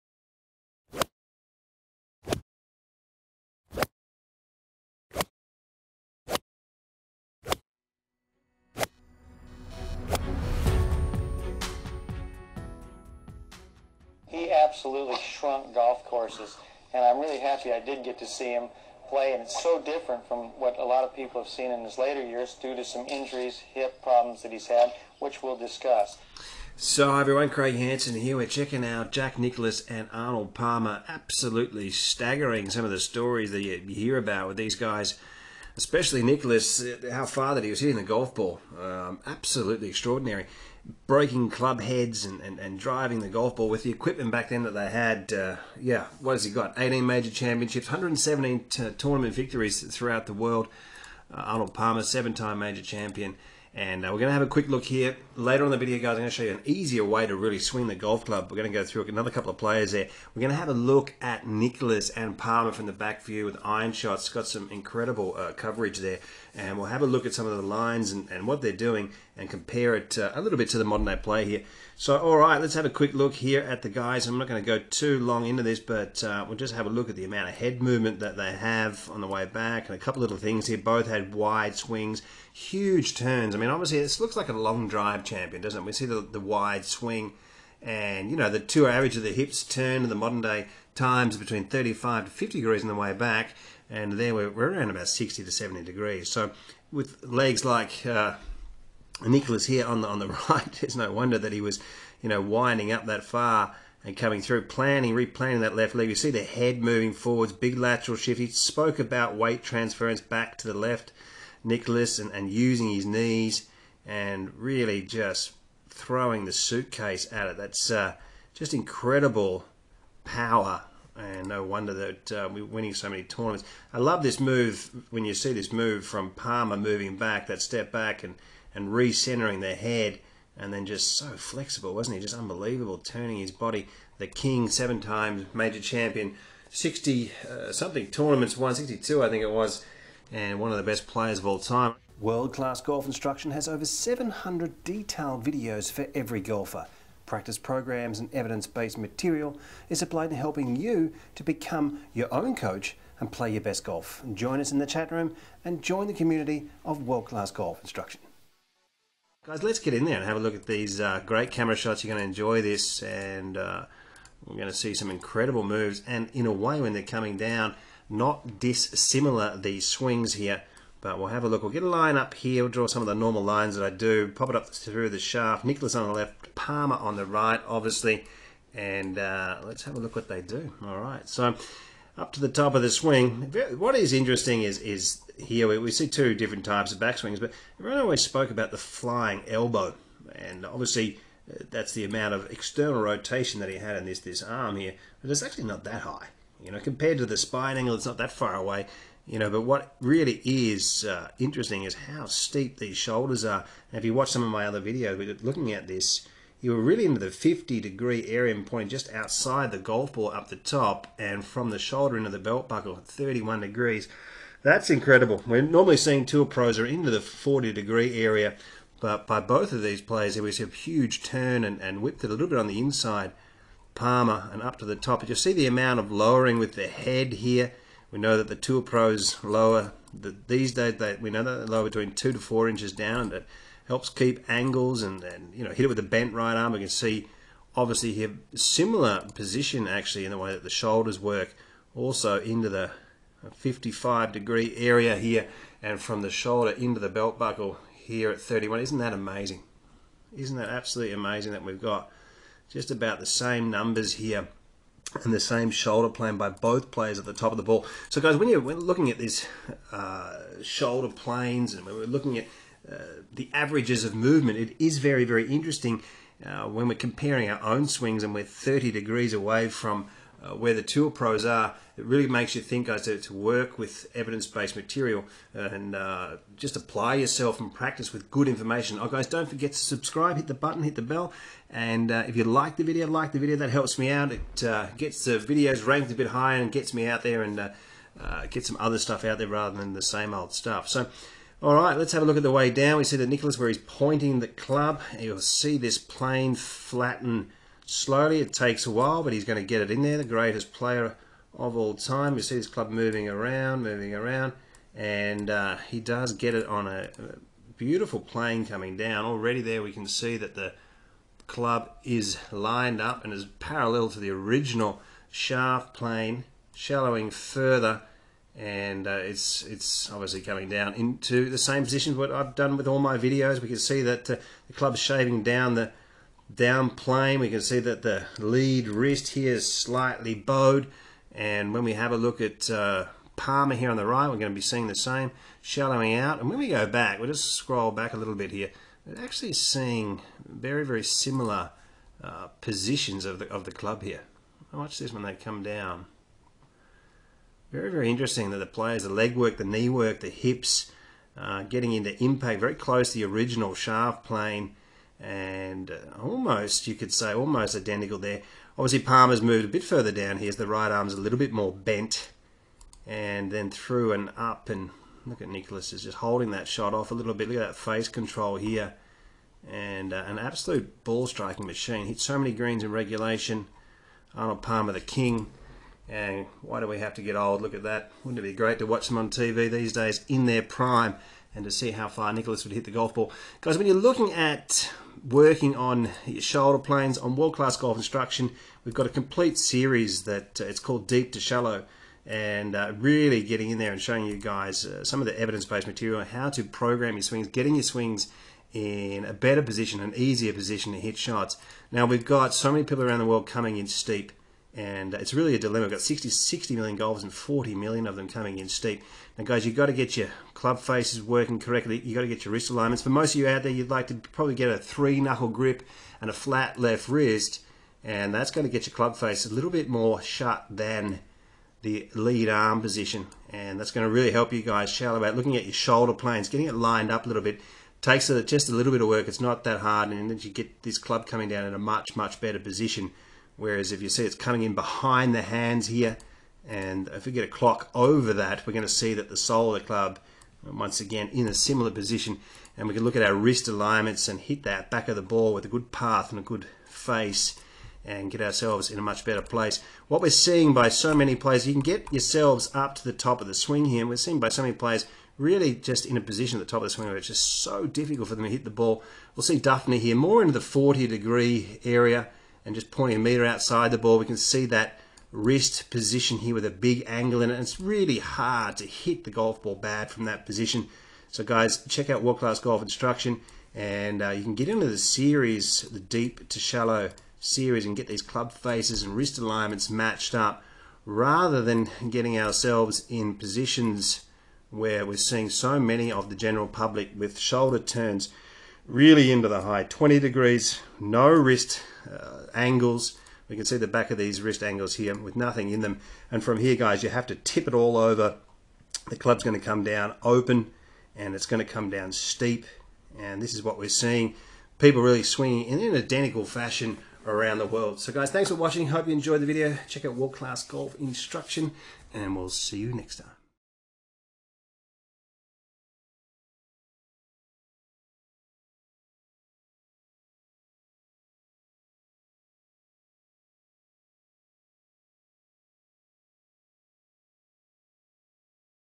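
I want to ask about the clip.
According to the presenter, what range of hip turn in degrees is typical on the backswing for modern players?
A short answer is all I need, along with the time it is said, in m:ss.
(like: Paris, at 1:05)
35 to 50 degrees, at 1:31.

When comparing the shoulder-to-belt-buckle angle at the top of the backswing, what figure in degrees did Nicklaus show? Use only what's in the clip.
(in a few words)
31 degrees.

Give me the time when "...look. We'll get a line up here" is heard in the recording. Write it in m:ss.
2:51.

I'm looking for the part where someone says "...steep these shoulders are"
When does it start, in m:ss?
3:22.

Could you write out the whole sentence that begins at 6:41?
Now we've got so many people around the world coming in steep and it's really a dilemma.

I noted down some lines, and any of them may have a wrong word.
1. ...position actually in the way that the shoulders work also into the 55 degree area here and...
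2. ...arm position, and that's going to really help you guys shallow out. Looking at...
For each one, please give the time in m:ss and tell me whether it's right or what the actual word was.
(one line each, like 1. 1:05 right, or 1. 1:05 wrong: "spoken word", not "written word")
1. 3:59 right
2. 7:02 right.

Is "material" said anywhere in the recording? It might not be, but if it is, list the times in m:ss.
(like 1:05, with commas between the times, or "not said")
2:28, 4:34, 6:35.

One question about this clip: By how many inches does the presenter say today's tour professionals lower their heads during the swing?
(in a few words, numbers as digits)
2 to 4 inches.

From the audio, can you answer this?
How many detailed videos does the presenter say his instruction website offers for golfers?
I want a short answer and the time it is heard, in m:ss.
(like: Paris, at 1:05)
Over 700, at 2:23.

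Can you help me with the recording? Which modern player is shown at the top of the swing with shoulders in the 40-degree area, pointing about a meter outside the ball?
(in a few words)
Dufner.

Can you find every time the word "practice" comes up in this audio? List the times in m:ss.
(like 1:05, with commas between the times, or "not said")
2:27, 4:37.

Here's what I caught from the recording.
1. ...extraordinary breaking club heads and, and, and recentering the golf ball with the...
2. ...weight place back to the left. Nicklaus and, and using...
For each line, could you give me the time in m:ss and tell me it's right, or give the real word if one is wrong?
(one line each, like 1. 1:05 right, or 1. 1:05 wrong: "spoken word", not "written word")
1. 0:39 wrong: "driving", not "recentering"
2. 1:49 wrong: "transference", not "place".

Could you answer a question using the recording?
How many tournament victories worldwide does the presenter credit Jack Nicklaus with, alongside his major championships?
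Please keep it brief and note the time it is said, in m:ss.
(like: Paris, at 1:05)
117, at 0:47.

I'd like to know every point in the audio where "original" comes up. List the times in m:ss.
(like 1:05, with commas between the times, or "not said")
5:14, 5:53.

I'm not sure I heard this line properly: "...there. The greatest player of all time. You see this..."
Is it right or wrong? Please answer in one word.
right.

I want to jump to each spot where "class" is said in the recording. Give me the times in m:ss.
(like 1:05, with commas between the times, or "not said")
2:22, 2:37, 6:27, 7:52, 8:30.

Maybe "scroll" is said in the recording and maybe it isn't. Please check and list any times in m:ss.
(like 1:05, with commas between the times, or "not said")
5:37.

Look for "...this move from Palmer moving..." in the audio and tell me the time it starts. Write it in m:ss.
2:05.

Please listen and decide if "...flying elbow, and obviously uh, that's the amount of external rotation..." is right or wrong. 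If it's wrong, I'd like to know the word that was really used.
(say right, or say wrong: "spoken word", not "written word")
right.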